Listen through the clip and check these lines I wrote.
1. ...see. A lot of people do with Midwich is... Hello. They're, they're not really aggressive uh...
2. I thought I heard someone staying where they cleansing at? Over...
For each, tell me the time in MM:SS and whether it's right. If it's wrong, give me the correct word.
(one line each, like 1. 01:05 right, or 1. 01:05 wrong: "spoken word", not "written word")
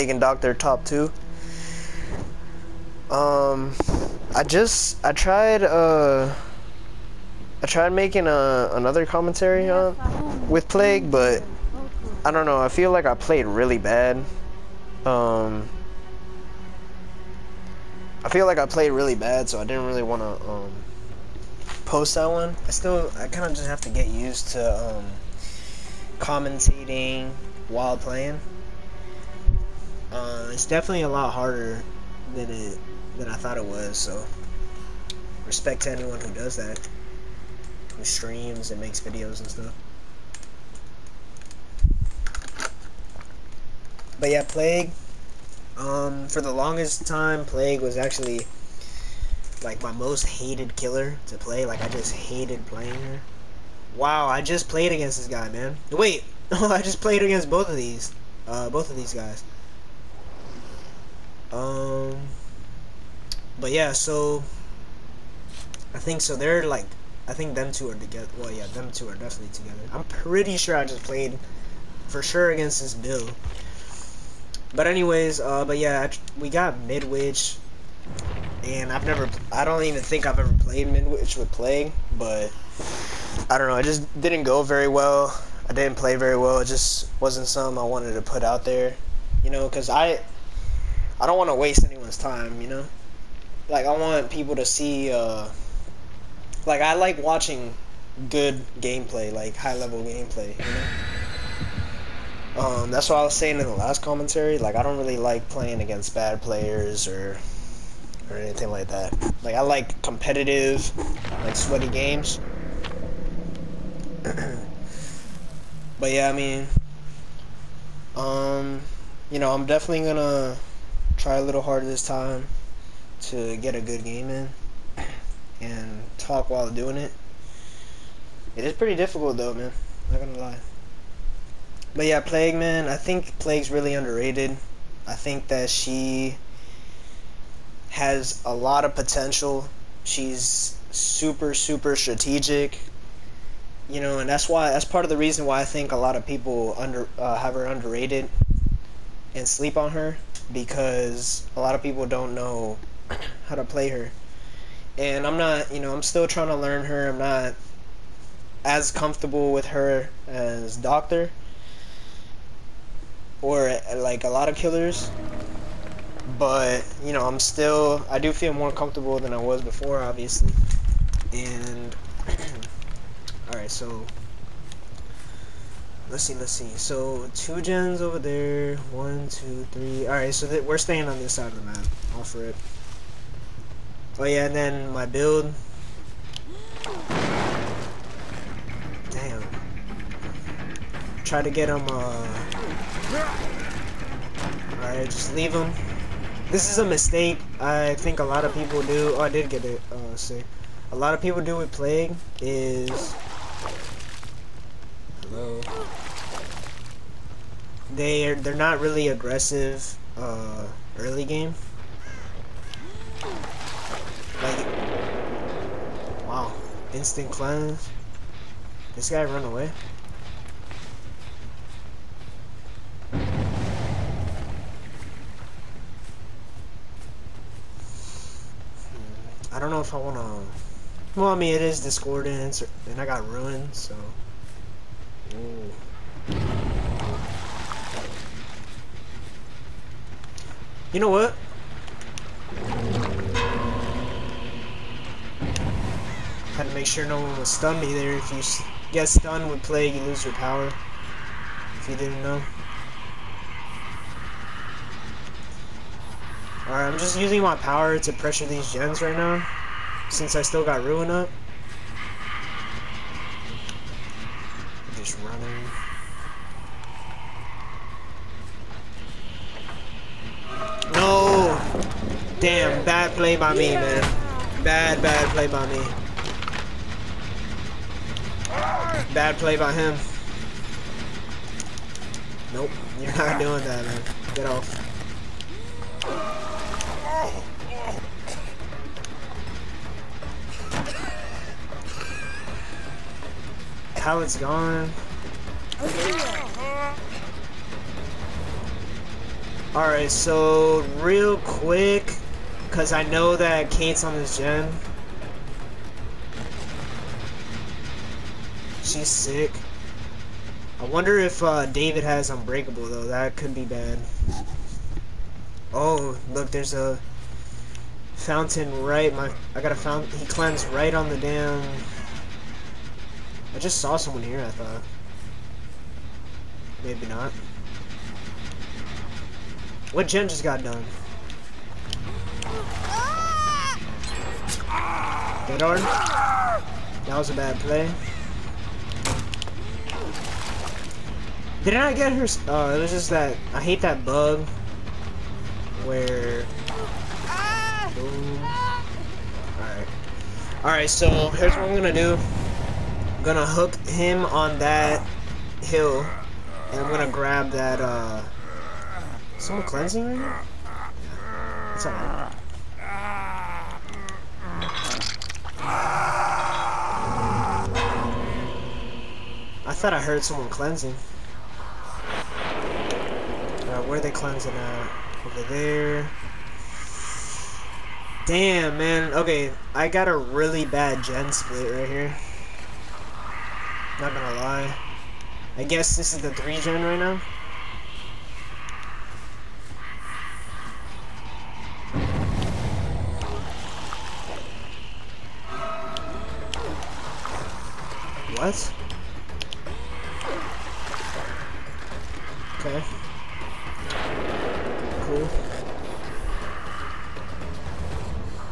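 1. 03:20 wrong: "Plague", not "Midwich"
2. 06:09 wrong: "cleansing", not "staying".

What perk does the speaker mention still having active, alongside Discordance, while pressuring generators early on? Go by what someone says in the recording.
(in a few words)
Ruin.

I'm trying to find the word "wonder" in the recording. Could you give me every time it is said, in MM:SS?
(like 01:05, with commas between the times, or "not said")
05:10.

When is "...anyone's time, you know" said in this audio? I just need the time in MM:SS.
01:31.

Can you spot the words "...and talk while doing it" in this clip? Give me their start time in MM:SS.
02:05.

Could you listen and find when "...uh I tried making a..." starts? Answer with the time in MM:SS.
00:05.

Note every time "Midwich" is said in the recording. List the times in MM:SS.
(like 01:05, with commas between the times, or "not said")
01:16, 01:20.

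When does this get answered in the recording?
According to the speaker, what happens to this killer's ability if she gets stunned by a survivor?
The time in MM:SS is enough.
04:09.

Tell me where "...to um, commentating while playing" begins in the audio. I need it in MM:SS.
00:24.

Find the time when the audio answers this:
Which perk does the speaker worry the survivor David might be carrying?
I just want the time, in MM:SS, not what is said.
05:12.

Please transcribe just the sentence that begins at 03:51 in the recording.
Well, I mean, it is Discordance, and I got ruined, so...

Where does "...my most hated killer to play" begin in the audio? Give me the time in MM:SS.
00:49.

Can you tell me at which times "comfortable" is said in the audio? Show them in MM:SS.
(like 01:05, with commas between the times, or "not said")
02:38, 02:48.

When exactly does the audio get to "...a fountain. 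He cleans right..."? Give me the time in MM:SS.
05:19.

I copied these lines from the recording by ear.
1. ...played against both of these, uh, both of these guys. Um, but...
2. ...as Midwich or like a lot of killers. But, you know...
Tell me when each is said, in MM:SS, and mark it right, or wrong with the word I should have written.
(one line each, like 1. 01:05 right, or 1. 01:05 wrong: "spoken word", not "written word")
1. 00:57 right
2. 02:40 wrong: "Doctor", not "Midwich".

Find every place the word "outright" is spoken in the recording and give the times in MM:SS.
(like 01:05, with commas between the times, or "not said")
not said.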